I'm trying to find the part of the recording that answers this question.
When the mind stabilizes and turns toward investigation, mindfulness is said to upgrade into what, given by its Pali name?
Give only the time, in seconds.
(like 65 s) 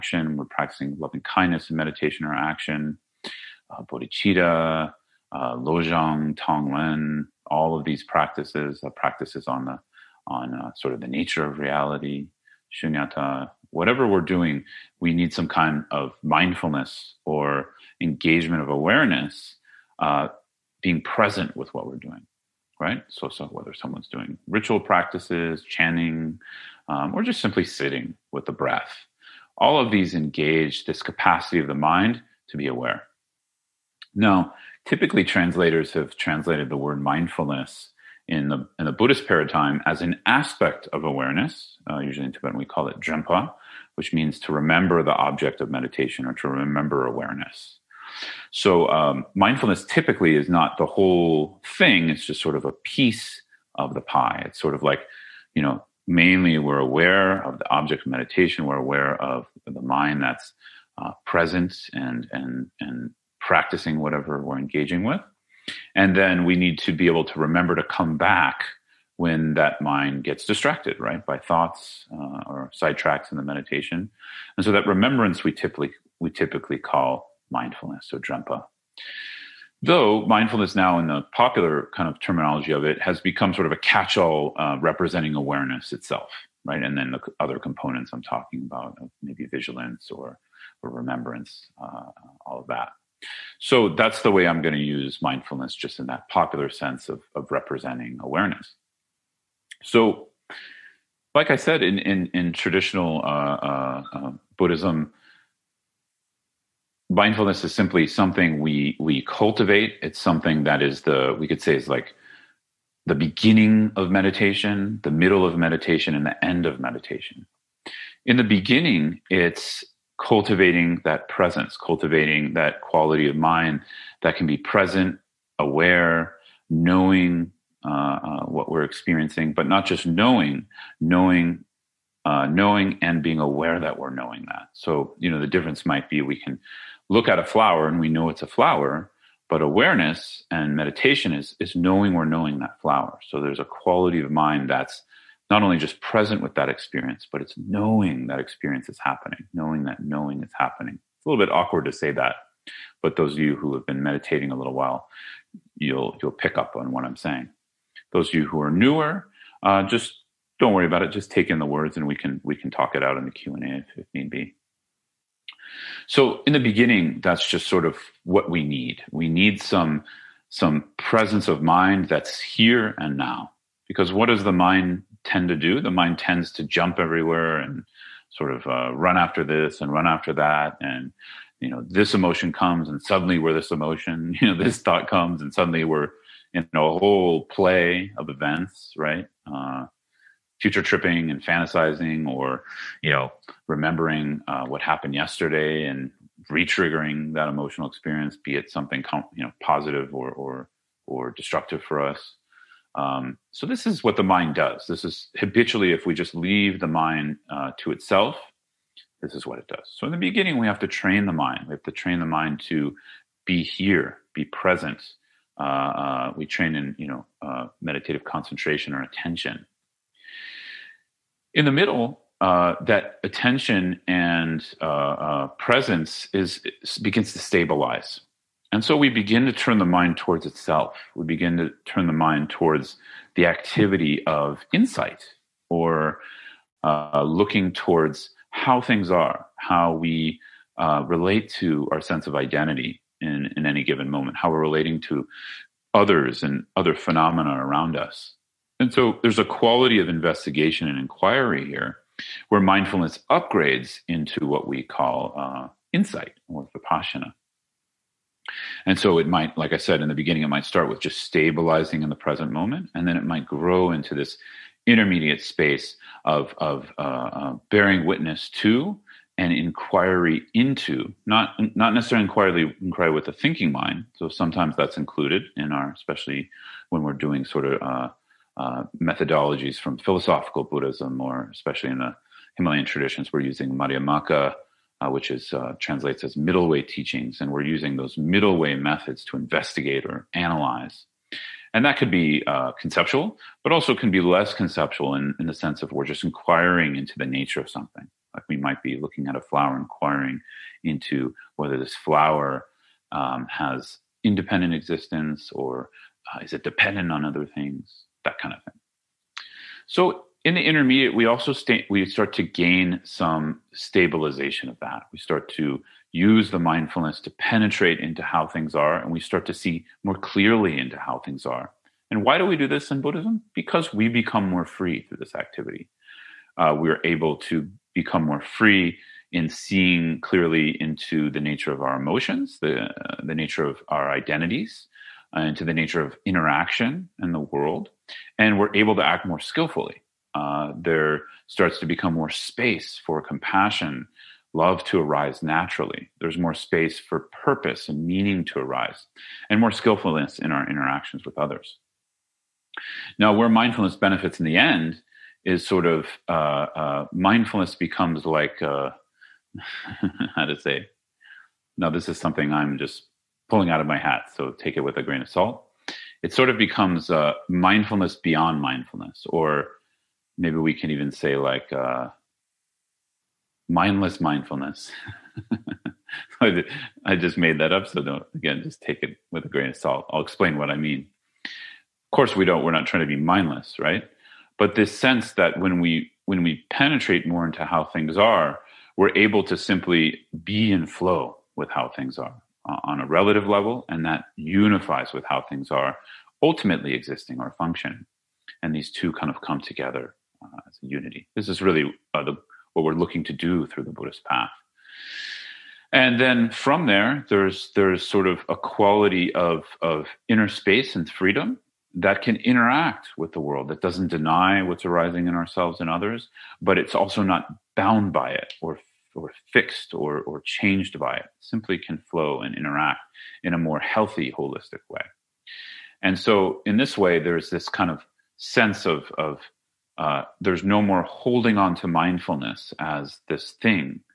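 256 s.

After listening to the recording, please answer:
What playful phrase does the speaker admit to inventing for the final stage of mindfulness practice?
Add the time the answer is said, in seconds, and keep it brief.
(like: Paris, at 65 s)
mindless mindfulness, at 373 s.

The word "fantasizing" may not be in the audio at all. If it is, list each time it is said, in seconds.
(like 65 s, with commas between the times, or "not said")
191 s.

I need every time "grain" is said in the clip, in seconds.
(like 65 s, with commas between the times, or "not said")
365 s, 379 s.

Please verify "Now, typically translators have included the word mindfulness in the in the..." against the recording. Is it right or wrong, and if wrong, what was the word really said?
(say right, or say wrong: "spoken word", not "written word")
wrong: "translated", not "included".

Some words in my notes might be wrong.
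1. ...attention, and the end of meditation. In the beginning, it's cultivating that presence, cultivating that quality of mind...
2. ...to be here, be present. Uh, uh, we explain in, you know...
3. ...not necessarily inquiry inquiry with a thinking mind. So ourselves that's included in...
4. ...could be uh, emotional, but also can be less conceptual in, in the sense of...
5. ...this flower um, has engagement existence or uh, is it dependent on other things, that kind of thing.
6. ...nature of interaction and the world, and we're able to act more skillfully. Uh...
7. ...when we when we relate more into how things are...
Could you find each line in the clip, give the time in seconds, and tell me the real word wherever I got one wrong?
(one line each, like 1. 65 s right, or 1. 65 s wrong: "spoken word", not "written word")
1. 115 s wrong: "meditation", not "attention"
2. 212 s wrong: "train", not "explain"
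3. 271 s wrong: "sometimes", not "ourselves"
4. 291 s wrong: "conceptual", not "emotional"
5. 301 s wrong: "independent", not "engagement"
6. 335 s right
7. 385 s wrong: "penetrate", not "relate".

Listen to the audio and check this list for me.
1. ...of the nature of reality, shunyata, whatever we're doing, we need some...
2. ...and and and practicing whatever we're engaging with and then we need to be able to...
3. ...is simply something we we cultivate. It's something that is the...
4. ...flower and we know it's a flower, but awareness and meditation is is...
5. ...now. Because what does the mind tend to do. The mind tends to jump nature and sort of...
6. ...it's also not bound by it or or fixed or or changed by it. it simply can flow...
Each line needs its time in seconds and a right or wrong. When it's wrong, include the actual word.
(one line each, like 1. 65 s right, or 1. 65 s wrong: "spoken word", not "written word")
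1. 10 s right
2. 61 s right
3. 107 s right
4. 137 s right
5. 173 s wrong: "everywhere", not "nature"
6. 416 s right.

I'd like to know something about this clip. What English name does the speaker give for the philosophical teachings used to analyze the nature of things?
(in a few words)
middle way teachings.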